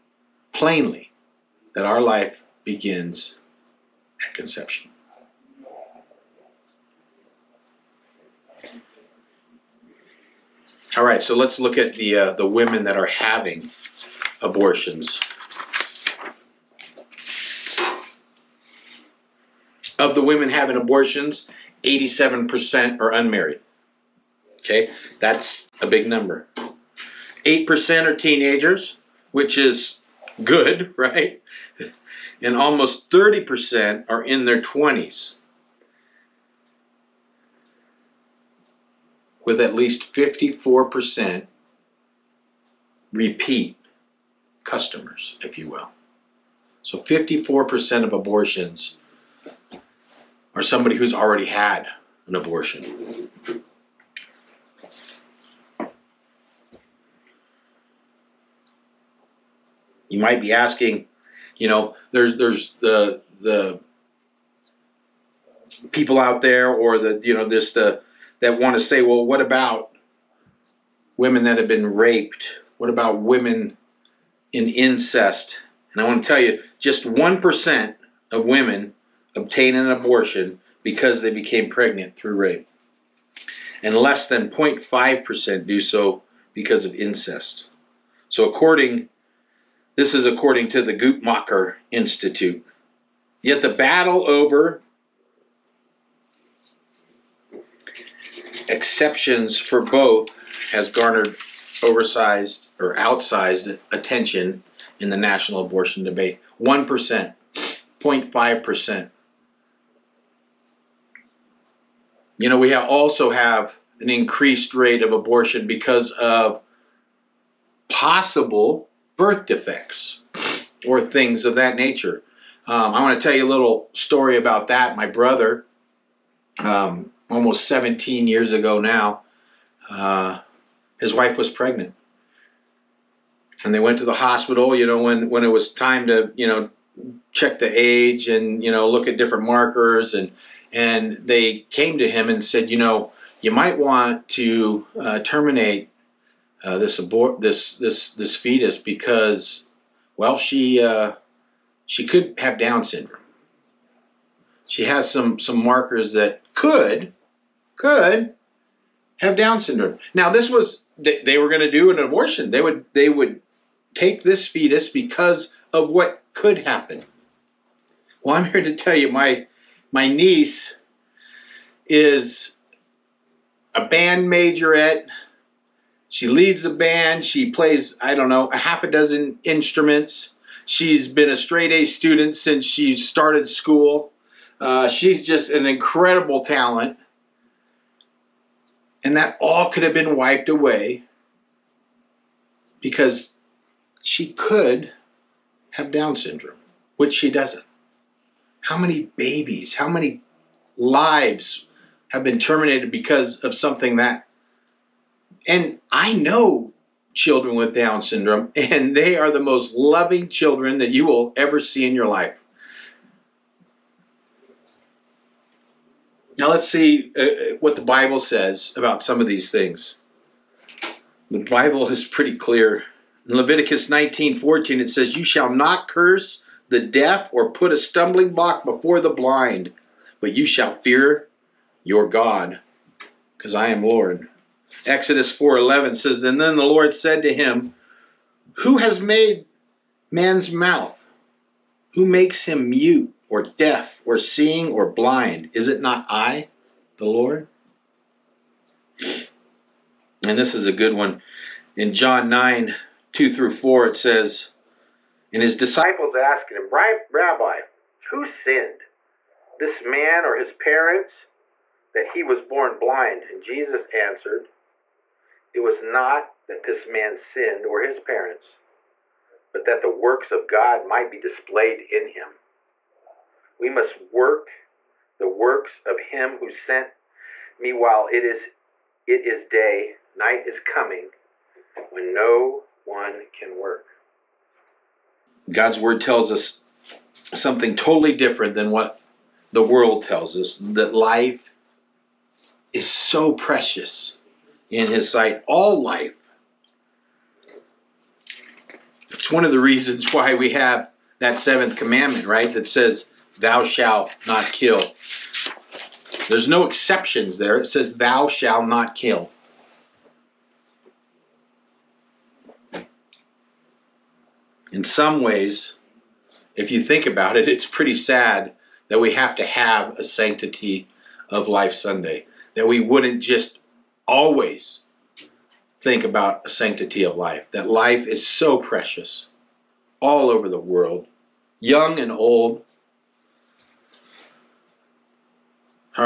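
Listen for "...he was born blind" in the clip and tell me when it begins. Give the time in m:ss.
4:22.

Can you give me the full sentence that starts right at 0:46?
So 54% of abortions are somebody who's already had an abortion.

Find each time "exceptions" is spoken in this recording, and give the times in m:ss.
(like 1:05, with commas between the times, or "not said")
1:38, 5:06.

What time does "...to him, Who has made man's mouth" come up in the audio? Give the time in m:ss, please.
3:57.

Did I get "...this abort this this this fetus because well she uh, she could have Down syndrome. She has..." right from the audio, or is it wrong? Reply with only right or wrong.
right.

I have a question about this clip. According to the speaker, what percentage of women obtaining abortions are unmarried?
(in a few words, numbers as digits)
87%.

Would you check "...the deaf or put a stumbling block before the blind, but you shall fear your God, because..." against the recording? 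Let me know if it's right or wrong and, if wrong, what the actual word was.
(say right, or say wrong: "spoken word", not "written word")
right.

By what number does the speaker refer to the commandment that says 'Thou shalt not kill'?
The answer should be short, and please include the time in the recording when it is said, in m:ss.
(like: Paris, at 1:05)
seventh, at 5:01.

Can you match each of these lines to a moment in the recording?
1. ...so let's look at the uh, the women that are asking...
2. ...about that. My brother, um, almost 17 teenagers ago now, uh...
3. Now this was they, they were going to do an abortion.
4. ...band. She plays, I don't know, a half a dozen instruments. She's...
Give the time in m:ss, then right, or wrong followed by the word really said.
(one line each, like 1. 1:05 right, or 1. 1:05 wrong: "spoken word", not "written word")
1. 0:11 wrong: "having", not "asking"
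2. 2:04 wrong: "years", not "teenagers"
3. 2:40 right
4. 2:56 right.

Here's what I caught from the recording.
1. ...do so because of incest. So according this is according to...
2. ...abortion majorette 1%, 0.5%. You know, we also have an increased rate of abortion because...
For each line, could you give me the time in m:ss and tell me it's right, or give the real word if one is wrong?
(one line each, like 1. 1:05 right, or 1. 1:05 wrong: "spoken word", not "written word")
1. 1:25 right
2. 1:45 wrong: "debate", not "majorette".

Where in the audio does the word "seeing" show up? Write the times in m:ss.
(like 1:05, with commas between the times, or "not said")
4:04.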